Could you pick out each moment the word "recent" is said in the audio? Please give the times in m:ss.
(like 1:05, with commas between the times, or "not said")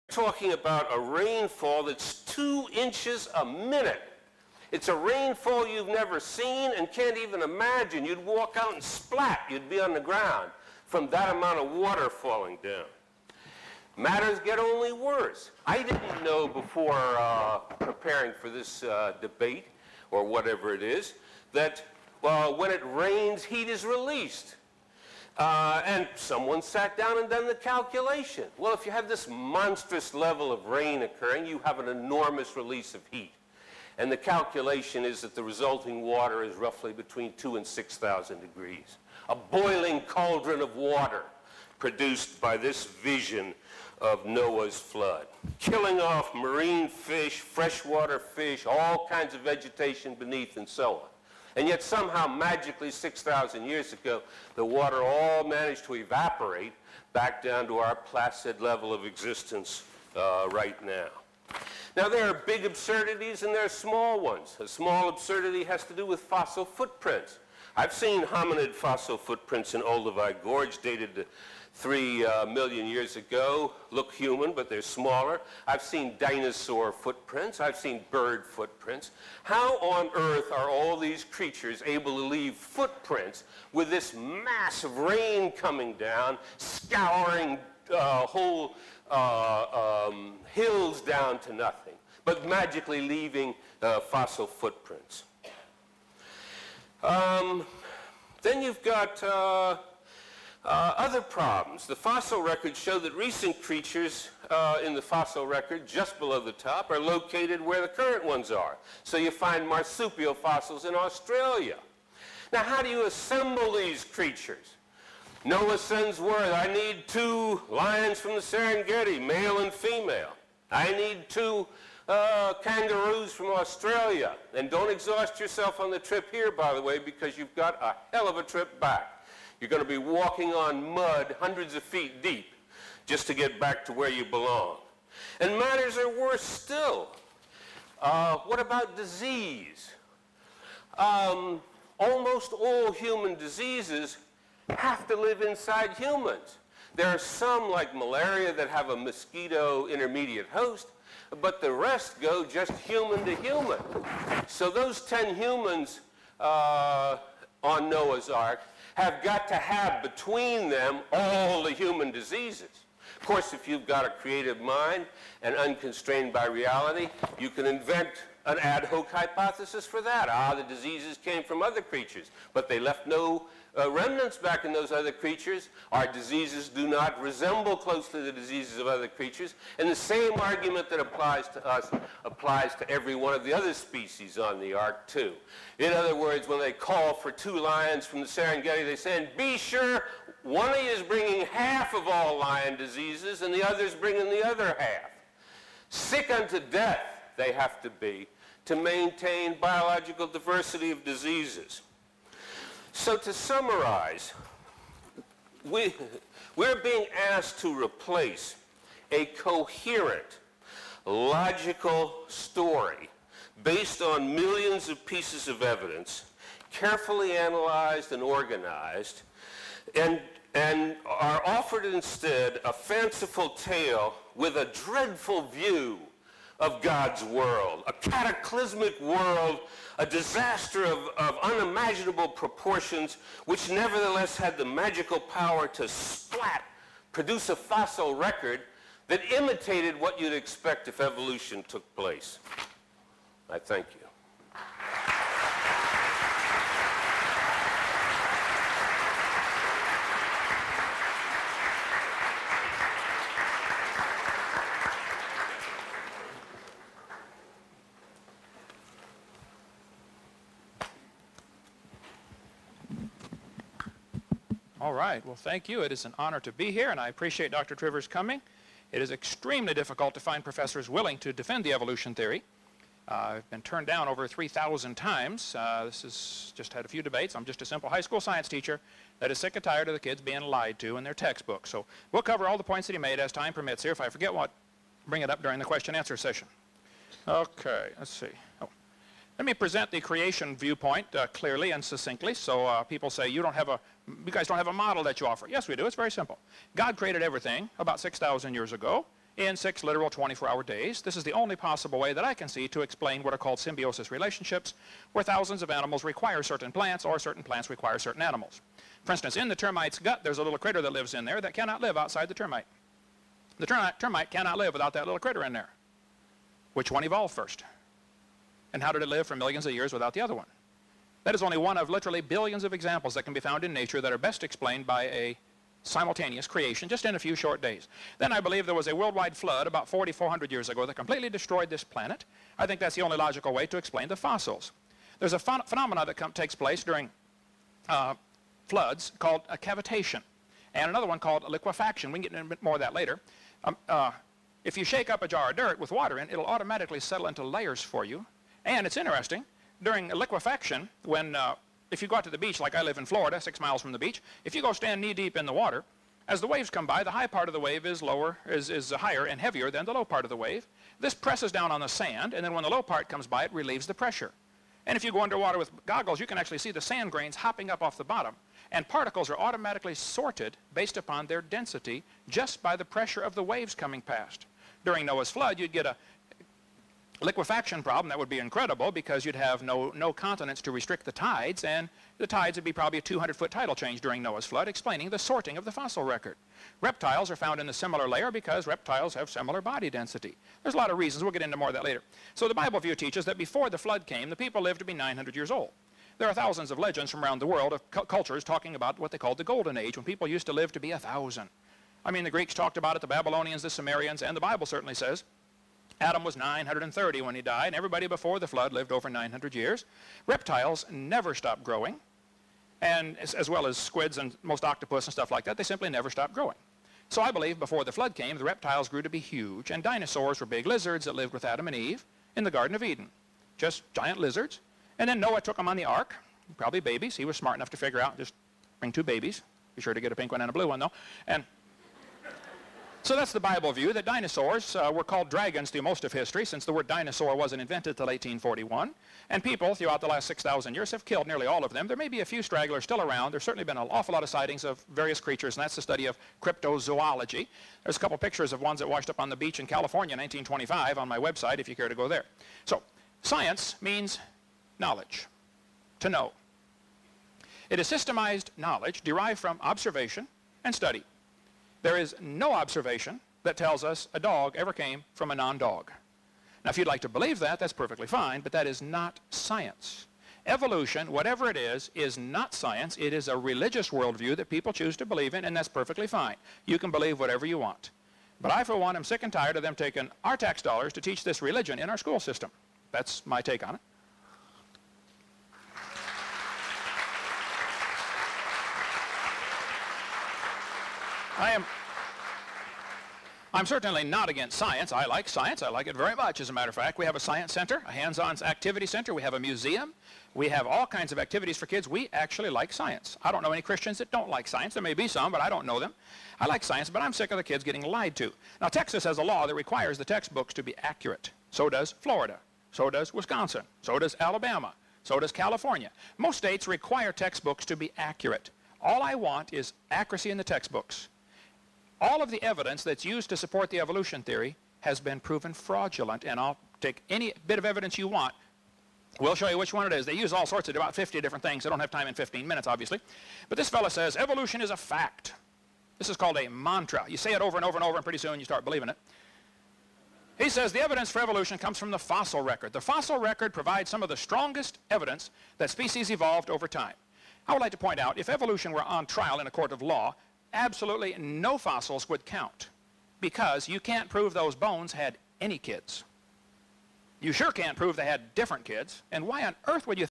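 1:43.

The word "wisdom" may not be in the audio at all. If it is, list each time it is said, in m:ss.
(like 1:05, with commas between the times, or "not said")
not said.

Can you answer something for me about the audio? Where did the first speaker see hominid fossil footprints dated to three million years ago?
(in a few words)
Olduvai Gorge.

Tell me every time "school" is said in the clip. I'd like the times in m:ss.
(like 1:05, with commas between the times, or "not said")
4:38, 8:01.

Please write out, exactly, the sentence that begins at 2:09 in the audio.
You're going to be walking on mud hundreds of feet deep just to get back to where you belong.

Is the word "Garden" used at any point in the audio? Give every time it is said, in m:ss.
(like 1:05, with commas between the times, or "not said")
7:02.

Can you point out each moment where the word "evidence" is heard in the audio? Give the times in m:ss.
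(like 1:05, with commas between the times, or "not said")
3:35, 8:42, 8:47, 9:00, 9:04.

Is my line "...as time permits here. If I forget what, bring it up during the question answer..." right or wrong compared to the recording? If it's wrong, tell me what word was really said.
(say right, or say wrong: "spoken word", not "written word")
right.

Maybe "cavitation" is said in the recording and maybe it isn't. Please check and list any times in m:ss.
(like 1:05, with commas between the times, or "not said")
5:39.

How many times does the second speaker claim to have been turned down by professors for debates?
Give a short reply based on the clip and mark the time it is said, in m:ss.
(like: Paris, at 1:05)
3,000, at 4:34.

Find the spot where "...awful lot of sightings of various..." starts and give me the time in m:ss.
7:23.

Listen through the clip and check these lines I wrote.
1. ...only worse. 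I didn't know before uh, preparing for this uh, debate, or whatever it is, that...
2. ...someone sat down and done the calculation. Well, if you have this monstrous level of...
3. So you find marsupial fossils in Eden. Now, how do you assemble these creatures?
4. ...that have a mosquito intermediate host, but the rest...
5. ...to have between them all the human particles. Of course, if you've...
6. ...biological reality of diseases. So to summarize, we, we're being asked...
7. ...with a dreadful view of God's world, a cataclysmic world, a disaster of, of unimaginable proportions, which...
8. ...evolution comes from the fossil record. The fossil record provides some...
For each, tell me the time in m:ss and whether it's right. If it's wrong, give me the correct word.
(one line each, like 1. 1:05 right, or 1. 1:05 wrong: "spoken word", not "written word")
1. 0:14 right
2. 0:26 right
3. 1:49 wrong: "Australia", not "Eden"
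4. 2:28 right
5. 2:39 wrong: "diseases", not "particles"
6. 3:19 wrong: "diversity", not "reality"
7. 3:44 right
8. 9:01 right.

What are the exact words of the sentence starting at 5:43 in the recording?
Um, uh, if you shake up a jar of dirt with water in, it, it'll automatically settle into layers for you.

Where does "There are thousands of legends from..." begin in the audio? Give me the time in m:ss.
6:36.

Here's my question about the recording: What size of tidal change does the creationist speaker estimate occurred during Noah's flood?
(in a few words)
200-foot.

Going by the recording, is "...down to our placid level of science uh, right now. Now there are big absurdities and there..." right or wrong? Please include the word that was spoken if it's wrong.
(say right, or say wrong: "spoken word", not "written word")
wrong: "existence", not "science".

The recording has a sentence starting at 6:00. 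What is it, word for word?
This presses down on the sand, and then when the low part comes by, it relieves the pressure.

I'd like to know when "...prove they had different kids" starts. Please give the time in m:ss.
9:17.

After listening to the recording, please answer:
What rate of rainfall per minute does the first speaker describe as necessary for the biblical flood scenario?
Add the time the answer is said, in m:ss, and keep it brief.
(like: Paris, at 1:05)
2 inches a minute, at 0:02.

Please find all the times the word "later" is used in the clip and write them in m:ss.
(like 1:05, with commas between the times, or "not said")
5:42, 6:31.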